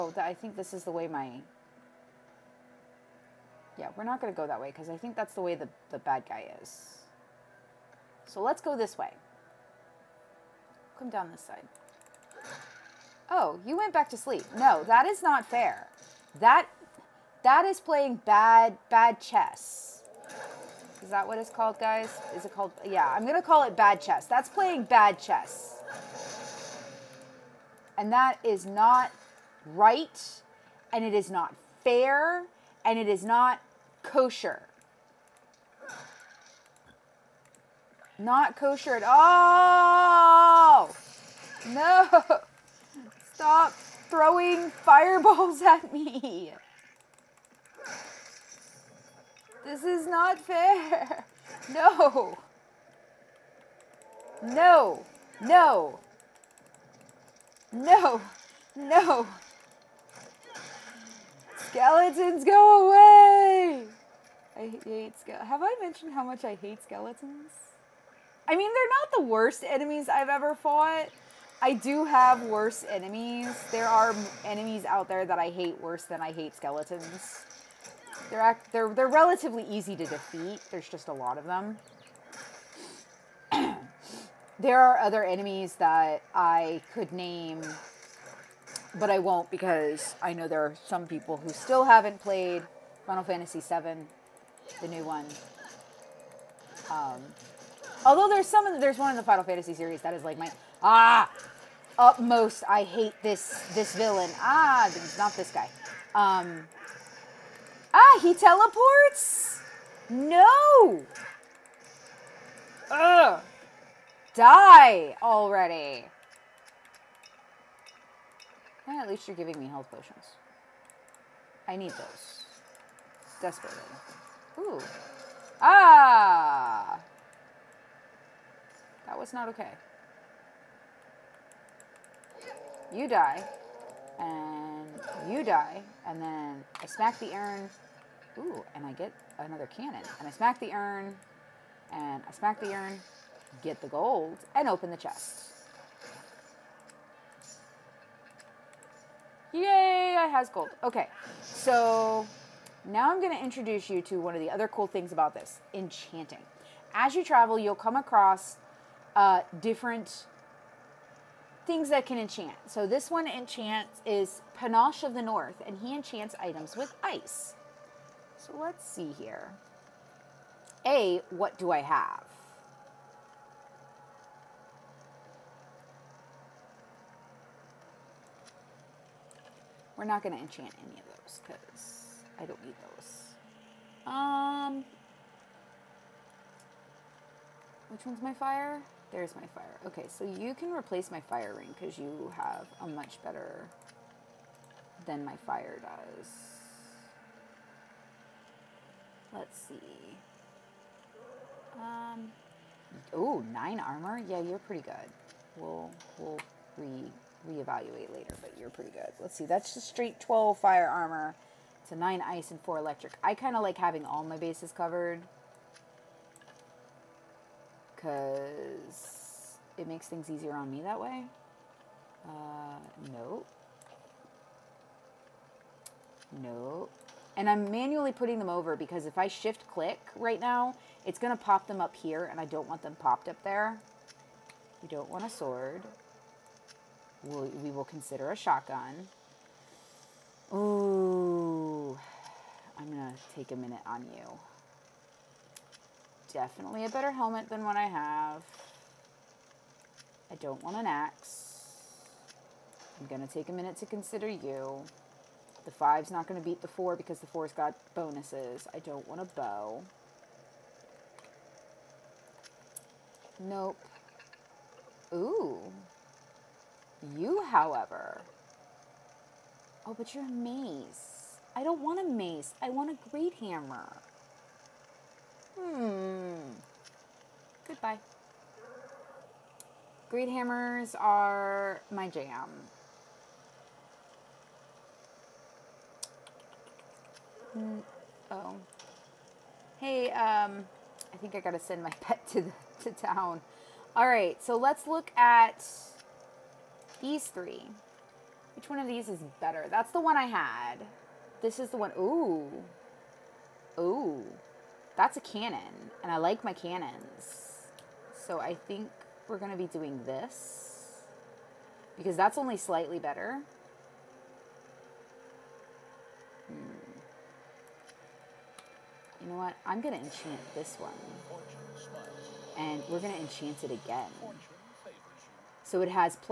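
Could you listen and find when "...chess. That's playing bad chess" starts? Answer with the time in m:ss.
0:24.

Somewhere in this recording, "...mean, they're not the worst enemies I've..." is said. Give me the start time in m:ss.
1:08.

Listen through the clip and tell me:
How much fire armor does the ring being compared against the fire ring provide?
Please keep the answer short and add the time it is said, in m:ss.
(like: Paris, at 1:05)
12, at 3:30.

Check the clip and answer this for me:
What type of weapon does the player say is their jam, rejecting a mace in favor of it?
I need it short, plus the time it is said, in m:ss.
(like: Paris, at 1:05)
great hammer, at 4:40.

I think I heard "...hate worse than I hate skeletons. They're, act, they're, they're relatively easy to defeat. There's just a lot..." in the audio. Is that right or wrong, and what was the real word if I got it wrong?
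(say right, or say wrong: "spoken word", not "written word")
right.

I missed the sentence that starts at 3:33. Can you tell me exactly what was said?
I kind of like having all my bases covered because it makes things easier on me that way.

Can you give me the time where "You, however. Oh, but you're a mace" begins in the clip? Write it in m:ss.
4:27.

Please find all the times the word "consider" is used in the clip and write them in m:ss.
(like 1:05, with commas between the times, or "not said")
3:57, 4:13.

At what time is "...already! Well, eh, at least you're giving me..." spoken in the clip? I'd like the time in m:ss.
1:55.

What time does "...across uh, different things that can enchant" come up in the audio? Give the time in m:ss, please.
2:37.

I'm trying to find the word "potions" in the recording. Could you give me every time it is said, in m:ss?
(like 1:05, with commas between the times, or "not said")
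1:59.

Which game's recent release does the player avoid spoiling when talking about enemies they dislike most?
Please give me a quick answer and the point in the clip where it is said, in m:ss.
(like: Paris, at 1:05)
Final Fantasy VII, at 1:33.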